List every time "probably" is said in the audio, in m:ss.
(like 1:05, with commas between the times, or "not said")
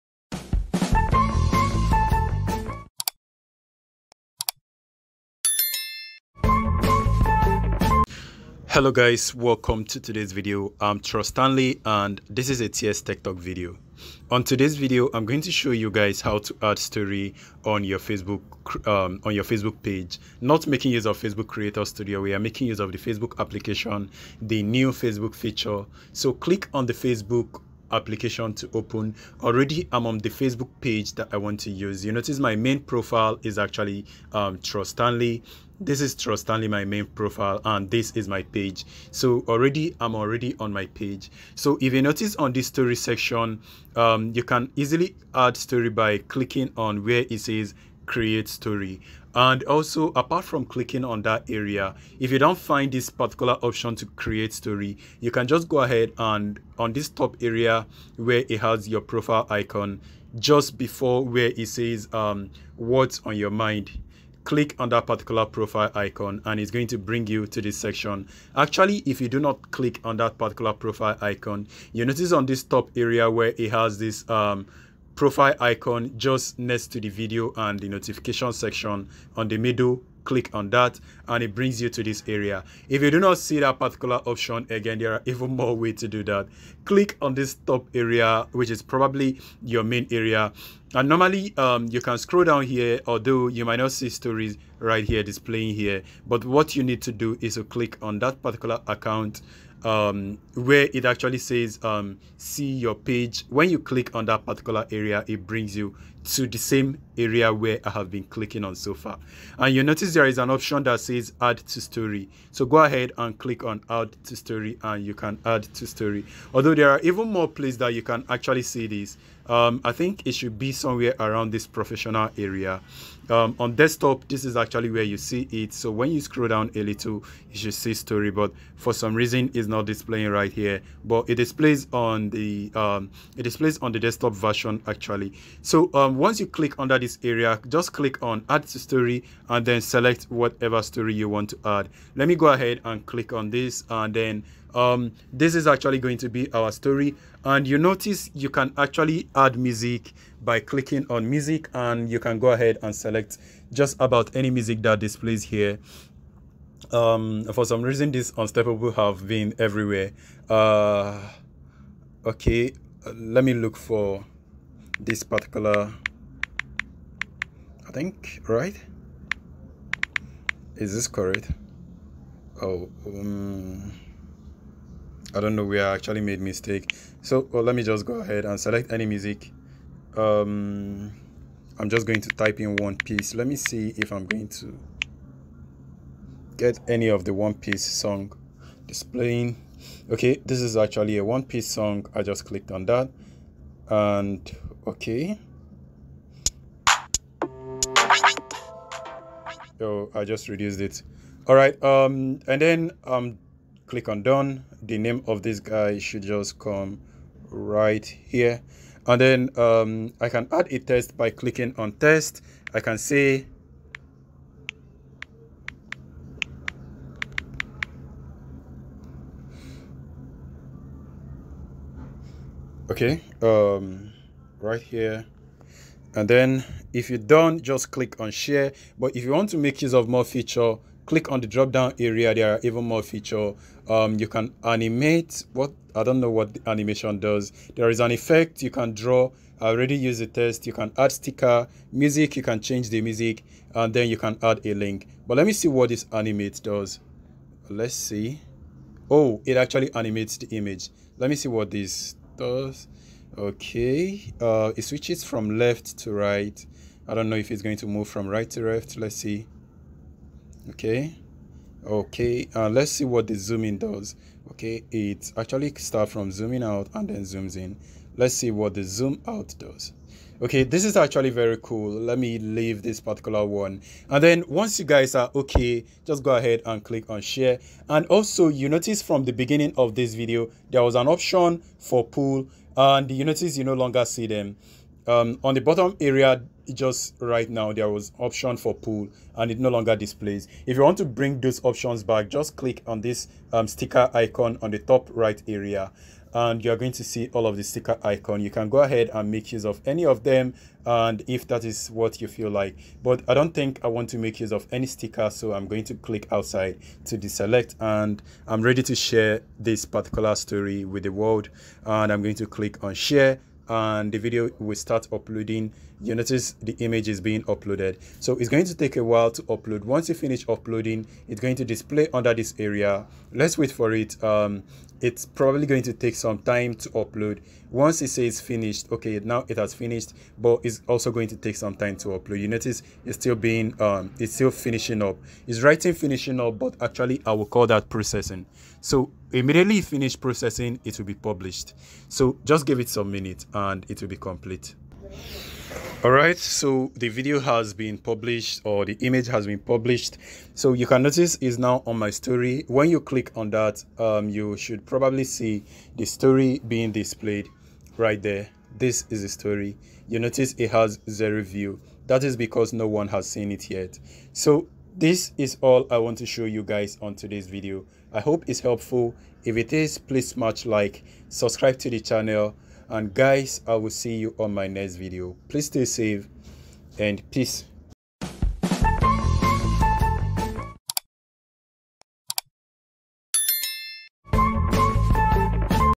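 1:28, 5:25, 5:54.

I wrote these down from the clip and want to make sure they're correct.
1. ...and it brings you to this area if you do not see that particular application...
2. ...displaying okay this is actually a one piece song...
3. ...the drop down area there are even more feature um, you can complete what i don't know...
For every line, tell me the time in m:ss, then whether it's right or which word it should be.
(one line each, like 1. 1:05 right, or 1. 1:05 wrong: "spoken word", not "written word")
1. 1:21 wrong: "option", not "application"
2. 3:08 right
3. 3:51 wrong: "animate", not "complete".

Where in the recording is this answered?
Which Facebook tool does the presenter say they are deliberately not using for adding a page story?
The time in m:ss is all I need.
0:21.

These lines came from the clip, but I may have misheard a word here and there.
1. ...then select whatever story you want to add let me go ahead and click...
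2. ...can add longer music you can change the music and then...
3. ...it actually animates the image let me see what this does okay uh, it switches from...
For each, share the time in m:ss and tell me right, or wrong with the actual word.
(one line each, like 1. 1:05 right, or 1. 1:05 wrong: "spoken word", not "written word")
1. 2:19 right
2. 4:00 wrong: "sticker", not "longer"
3. 4:09 right.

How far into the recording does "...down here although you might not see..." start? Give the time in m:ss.
1:32.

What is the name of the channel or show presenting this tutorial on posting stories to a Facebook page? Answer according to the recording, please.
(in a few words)
TS Tech Talk.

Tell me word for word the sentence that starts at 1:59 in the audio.
Um, I think it should be somewhere around this professional area.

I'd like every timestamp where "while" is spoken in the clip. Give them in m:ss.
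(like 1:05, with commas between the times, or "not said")
5:19.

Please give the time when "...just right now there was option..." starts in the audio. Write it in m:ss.
4:46.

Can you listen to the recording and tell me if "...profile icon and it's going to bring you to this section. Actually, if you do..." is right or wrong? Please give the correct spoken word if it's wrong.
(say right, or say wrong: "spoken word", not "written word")
right.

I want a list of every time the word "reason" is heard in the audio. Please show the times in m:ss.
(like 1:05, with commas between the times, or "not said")
2:09, 2:37.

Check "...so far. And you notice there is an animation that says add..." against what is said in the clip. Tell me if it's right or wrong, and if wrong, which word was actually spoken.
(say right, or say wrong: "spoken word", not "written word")
wrong: "option", not "animation".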